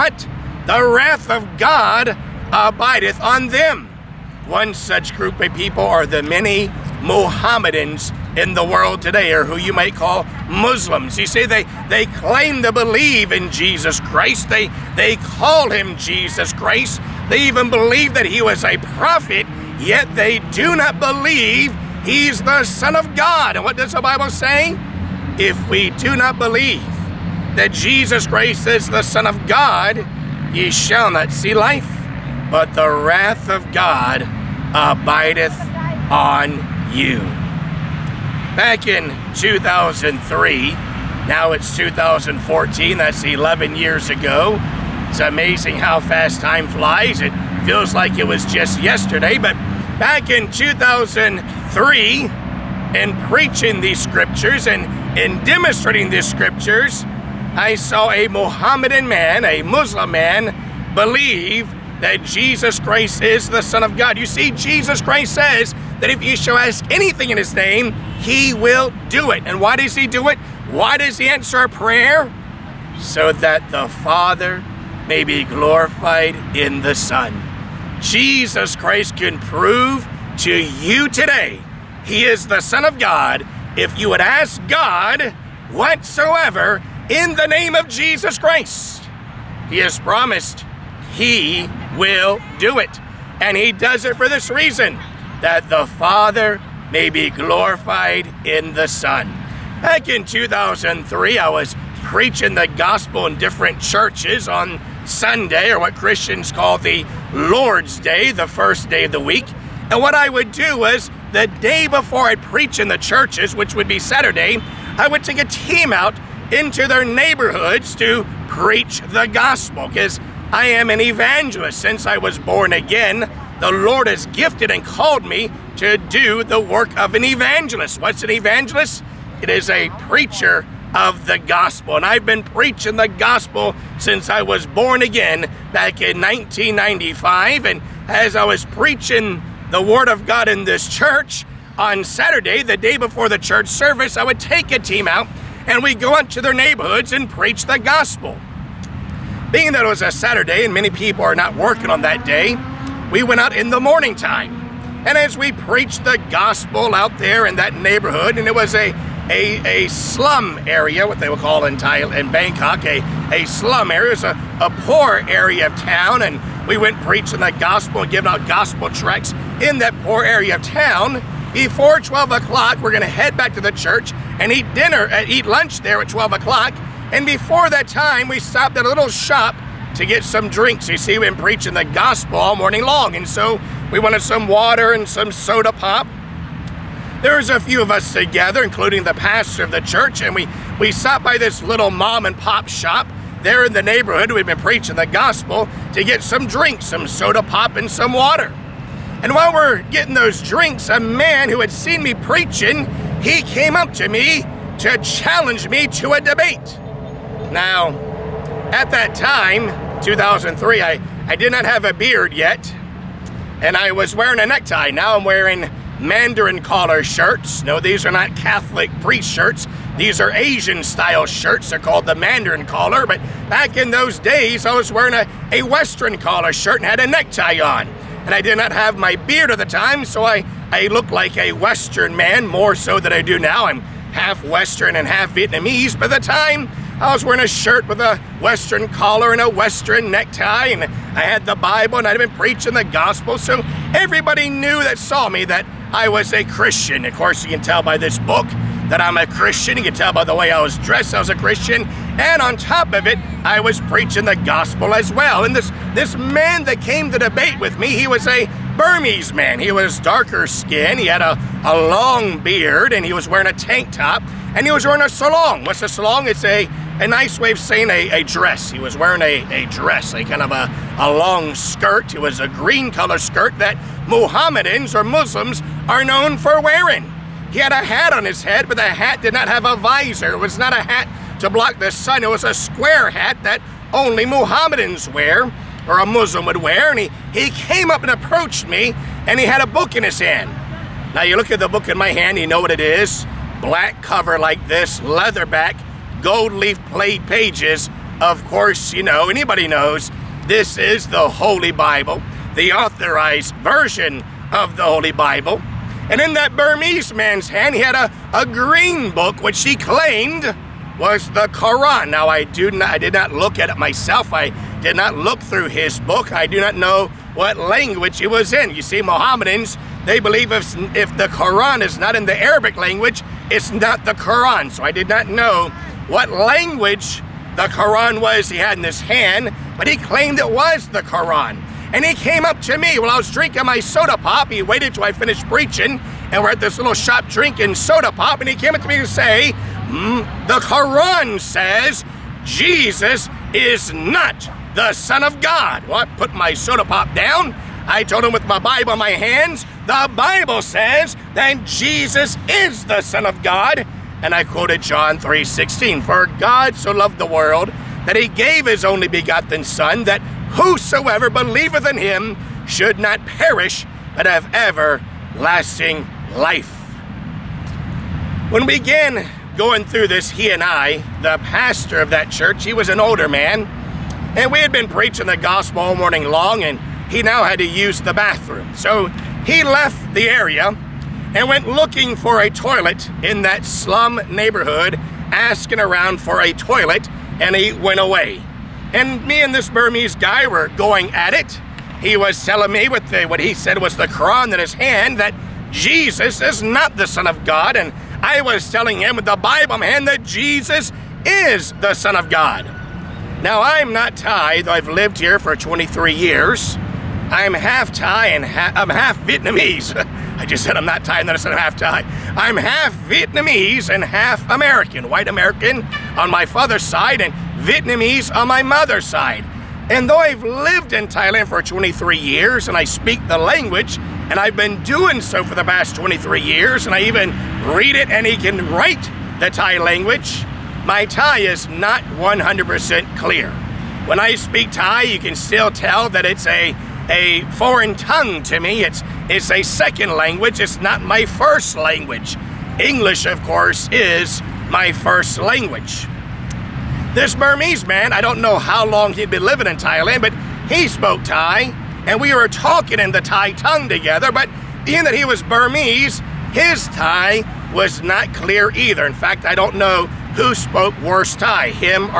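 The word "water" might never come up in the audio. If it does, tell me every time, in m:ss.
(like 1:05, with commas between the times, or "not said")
3:04, 3:18.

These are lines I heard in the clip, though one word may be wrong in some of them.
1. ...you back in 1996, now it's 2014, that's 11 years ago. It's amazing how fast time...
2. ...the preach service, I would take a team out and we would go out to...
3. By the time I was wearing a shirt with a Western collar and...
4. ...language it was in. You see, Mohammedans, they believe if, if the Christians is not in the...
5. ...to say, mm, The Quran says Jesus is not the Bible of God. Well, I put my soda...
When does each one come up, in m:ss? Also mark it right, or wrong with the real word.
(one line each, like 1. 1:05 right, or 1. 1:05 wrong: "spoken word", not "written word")
1. 0:36 wrong: "2003", not "1996"
2. 2:23 wrong: "church", not "preach"
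3. 3:55 right
4. 5:17 wrong: "Quran", not "Christians"
5. 5:38 wrong: "Son", not "Bible".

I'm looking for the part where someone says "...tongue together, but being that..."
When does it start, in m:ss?
7:33.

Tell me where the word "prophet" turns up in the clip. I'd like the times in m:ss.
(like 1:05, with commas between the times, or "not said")
0:18.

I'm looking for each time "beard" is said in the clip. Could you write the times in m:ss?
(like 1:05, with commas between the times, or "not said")
3:31, 3:49, 4:22.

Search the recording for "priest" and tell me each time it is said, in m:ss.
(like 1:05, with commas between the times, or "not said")
3:39.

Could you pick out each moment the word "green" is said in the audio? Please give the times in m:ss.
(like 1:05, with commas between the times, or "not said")
4:32, 5:08.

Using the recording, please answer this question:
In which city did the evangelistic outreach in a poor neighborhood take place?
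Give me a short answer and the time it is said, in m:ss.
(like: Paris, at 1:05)
Bangkok, at 2:42.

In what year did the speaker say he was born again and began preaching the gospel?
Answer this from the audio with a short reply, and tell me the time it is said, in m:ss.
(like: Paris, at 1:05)
1995, at 2:16.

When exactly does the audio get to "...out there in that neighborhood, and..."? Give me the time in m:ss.
2:36.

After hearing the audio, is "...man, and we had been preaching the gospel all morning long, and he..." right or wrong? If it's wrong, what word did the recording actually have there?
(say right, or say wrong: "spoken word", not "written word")
right.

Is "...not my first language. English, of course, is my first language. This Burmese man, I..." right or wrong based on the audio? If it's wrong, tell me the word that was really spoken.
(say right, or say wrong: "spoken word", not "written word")
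right.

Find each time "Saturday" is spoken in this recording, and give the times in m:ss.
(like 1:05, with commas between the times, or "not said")
1:53, 2:22, 2:30.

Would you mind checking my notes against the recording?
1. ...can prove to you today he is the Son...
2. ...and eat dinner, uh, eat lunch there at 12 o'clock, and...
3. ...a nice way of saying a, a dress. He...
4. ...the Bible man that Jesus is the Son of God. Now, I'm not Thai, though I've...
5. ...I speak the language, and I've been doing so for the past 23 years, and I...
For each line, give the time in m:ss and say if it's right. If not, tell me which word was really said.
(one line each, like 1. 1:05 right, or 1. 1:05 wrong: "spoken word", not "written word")
1. 1:19 right
2. 2:54 right
3. 4:27 right
4. 6:39 right
5. 7:02 right.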